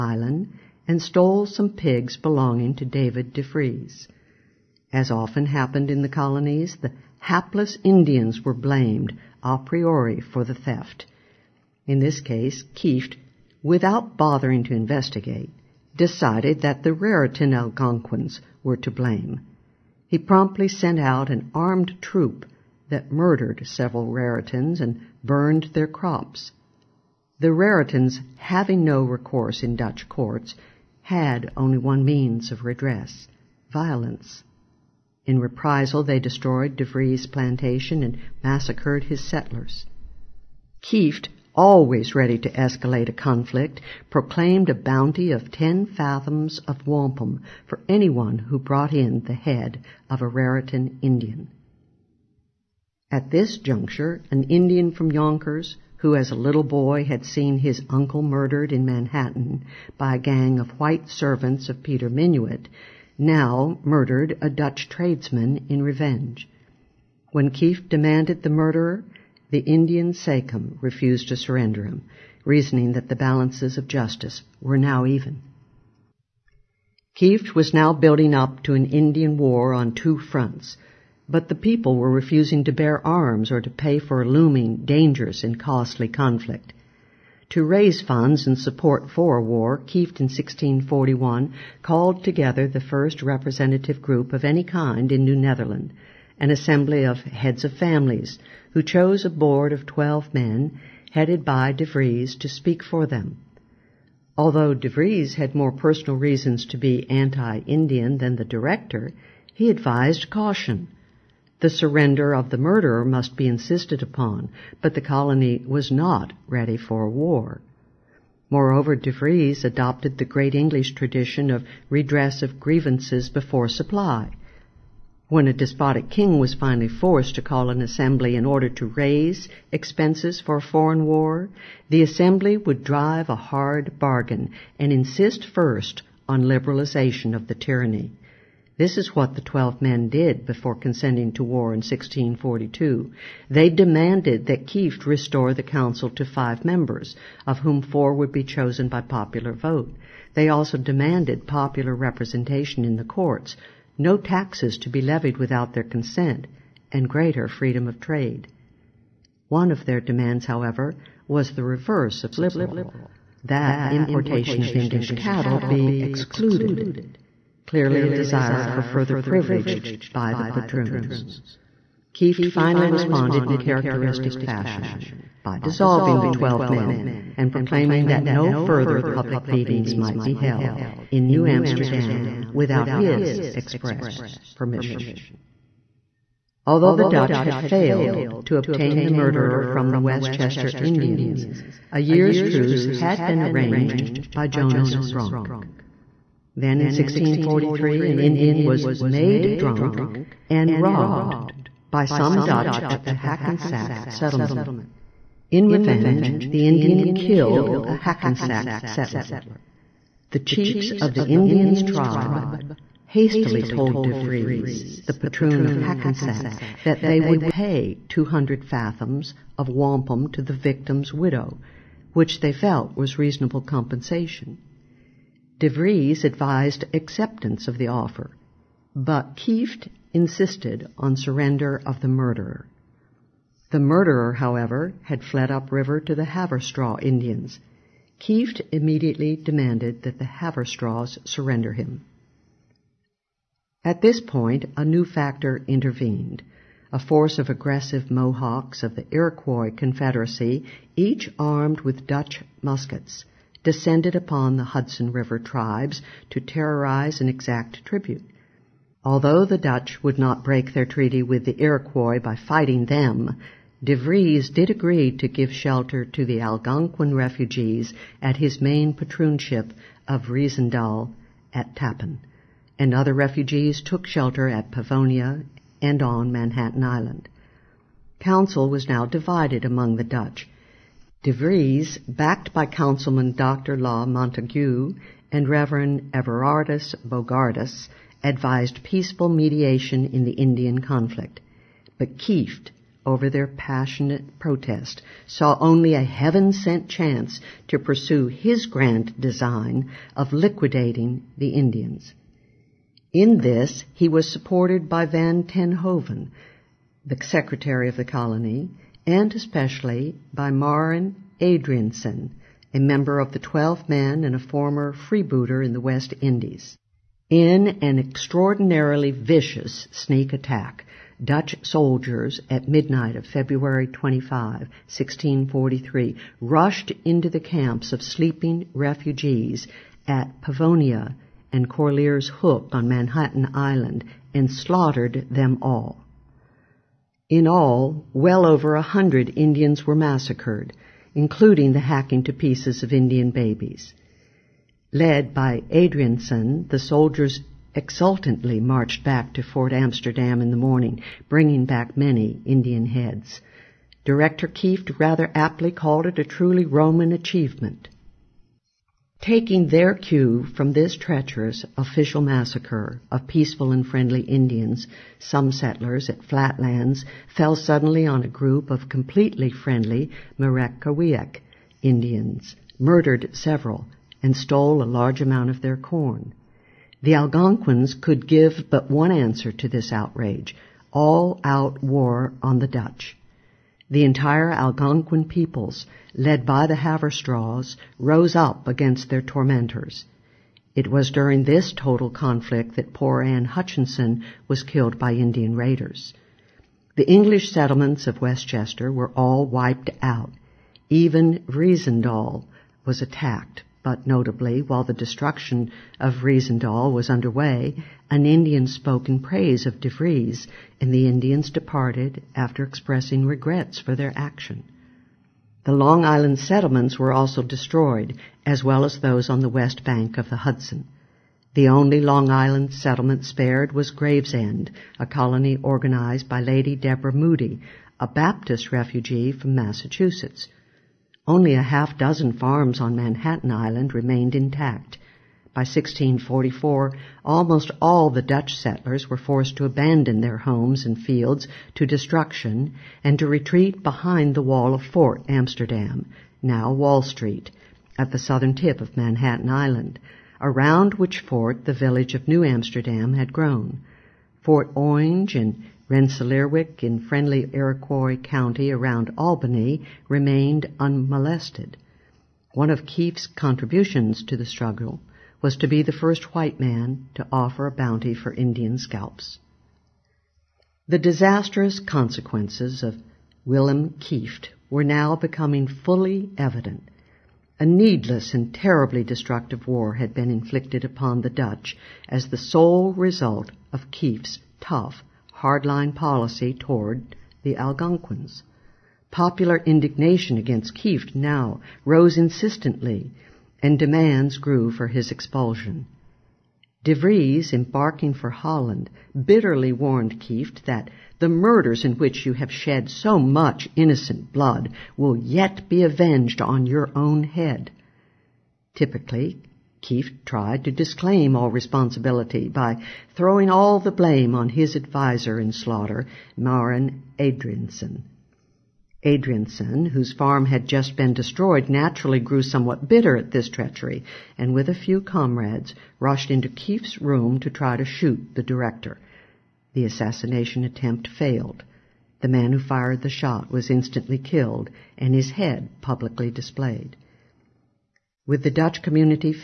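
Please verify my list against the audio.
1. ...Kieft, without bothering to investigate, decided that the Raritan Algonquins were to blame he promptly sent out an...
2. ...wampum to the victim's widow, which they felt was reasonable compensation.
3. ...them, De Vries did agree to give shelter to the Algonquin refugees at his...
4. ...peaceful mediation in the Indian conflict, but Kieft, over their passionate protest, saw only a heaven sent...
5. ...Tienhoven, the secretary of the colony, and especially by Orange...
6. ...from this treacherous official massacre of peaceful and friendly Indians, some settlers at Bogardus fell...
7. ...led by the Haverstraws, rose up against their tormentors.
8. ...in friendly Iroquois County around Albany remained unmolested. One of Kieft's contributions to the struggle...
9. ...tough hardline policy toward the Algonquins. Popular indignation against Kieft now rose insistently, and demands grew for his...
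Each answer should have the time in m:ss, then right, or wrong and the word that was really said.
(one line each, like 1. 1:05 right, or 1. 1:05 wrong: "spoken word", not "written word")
1. 0:12 right
2. 3:39 right
3. 4:22 right
4. 4:48 right
5. 5:05 wrong: "Marin", not "Orange"
6. 6:00 wrong: "Flatlands", not "Bogardus"
7. 6:26 right
8. 7:36 right
9. 8:04 right.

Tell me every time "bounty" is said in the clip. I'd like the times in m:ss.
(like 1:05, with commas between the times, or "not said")
0:44, 7:47.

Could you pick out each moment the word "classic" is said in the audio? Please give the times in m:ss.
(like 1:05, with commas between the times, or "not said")
not said.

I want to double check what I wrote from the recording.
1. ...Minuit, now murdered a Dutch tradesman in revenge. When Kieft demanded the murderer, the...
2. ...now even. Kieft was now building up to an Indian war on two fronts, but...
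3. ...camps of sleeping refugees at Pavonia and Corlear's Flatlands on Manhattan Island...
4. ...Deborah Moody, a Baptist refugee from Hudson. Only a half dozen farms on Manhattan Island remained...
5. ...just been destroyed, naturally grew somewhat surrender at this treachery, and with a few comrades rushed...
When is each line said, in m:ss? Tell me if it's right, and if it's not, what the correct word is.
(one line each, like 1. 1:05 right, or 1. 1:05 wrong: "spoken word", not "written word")
1. 1:02 right
2. 1:14 right
3. 5:27 wrong: "Hook", not "Flatlands"
4. 7:06 wrong: "Massachusetts", not "Hudson"
5. 8:40 wrong: "bitter", not "surrender".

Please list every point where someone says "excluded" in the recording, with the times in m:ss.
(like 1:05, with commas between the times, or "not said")
2:46.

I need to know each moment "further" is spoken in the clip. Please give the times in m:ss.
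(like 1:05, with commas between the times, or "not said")
2:48, 2:58.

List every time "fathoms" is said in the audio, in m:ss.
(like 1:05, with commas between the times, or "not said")
0:45, 3:38.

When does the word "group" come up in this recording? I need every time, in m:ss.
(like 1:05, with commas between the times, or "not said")
1:34, 6:08.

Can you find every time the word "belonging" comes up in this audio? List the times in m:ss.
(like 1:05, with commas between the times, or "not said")
0:02.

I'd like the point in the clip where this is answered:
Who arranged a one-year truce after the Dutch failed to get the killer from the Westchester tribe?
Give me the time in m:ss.
3:14.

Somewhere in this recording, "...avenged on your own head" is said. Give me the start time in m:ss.
8:25.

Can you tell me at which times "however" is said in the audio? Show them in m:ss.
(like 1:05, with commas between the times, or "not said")
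2:40, 3:54.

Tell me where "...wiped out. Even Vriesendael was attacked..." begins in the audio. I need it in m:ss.
6:39.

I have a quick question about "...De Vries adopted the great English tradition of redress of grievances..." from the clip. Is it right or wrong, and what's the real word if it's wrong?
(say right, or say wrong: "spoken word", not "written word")
right.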